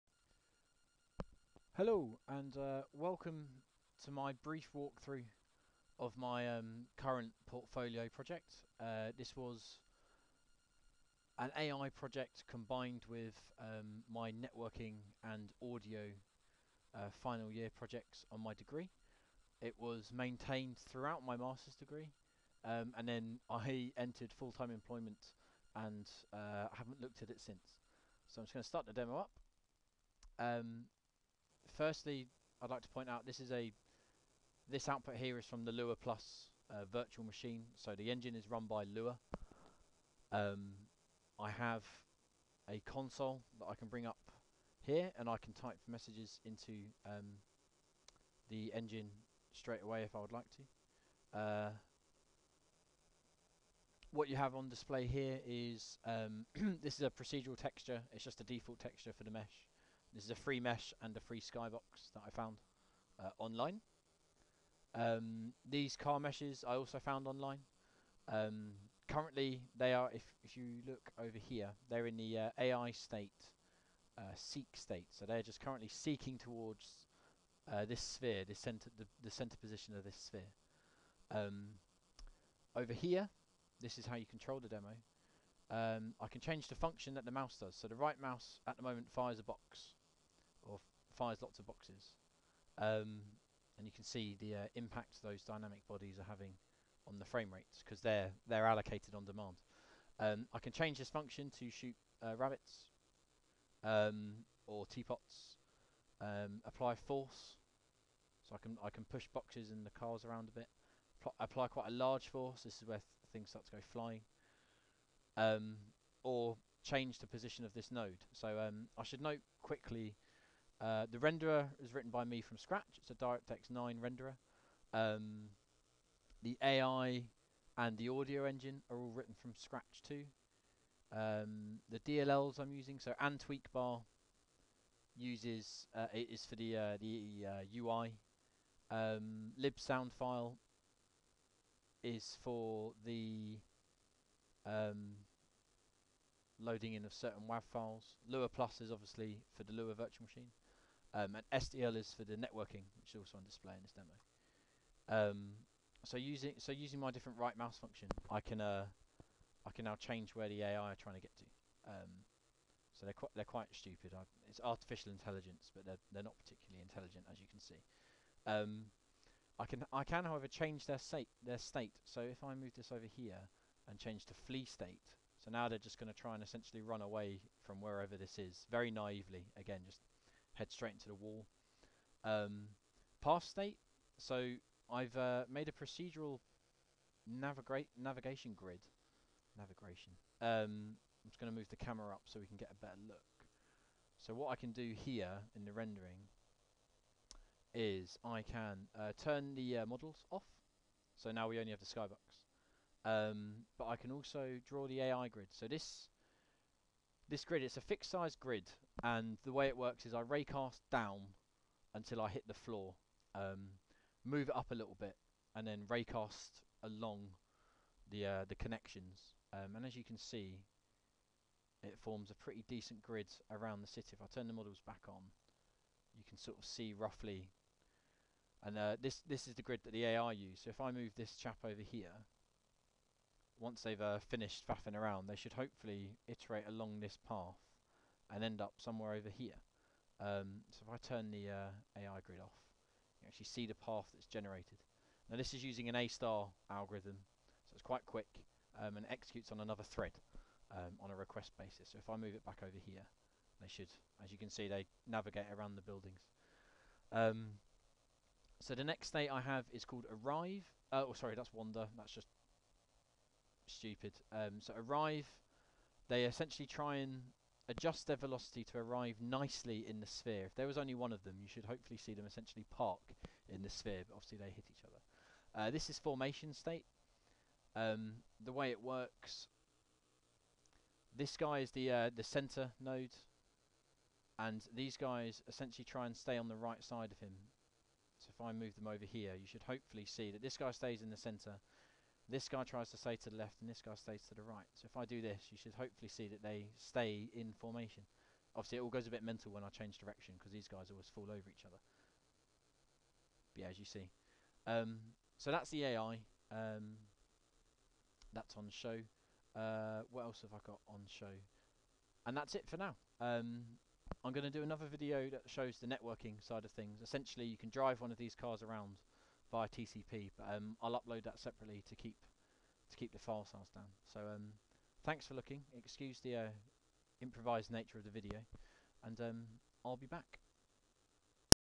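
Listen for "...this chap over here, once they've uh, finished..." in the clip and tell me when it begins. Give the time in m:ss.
3:51.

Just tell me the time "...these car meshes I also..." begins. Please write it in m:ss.
1:05.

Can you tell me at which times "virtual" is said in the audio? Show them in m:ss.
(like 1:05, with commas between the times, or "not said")
0:36, 2:29.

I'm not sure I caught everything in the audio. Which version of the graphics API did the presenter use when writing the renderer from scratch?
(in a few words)
DirectX 9.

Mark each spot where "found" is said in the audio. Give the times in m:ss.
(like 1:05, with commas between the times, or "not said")
1:02, 1:06.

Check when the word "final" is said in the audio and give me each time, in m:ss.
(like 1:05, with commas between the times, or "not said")
0:17.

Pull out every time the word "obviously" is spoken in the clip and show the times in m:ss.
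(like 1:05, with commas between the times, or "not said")
2:28, 4:34, 4:58.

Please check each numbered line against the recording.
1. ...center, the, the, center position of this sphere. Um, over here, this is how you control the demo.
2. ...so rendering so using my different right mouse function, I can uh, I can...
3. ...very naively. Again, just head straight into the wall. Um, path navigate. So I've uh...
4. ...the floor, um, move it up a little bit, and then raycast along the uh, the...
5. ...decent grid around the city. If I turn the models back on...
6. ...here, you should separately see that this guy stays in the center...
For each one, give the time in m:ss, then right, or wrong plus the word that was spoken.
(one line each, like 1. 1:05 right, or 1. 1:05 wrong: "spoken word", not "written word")
1. 1:18 right
2. 2:36 wrong: "using", not "rendering"
3. 2:58 wrong: "state", not "navigate"
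4. 3:32 right
5. 3:42 right
6. 4:49 wrong: "hopefully", not "separately".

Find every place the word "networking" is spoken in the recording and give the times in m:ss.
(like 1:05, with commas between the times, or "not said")
0:14, 2:32, 5:15.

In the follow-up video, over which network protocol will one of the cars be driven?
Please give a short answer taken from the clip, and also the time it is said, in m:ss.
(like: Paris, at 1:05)
TCP, at 5:19.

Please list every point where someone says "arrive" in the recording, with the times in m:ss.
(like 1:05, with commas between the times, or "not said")
4:20, 4:24, 4:28.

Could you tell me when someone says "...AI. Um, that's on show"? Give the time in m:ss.
5:05.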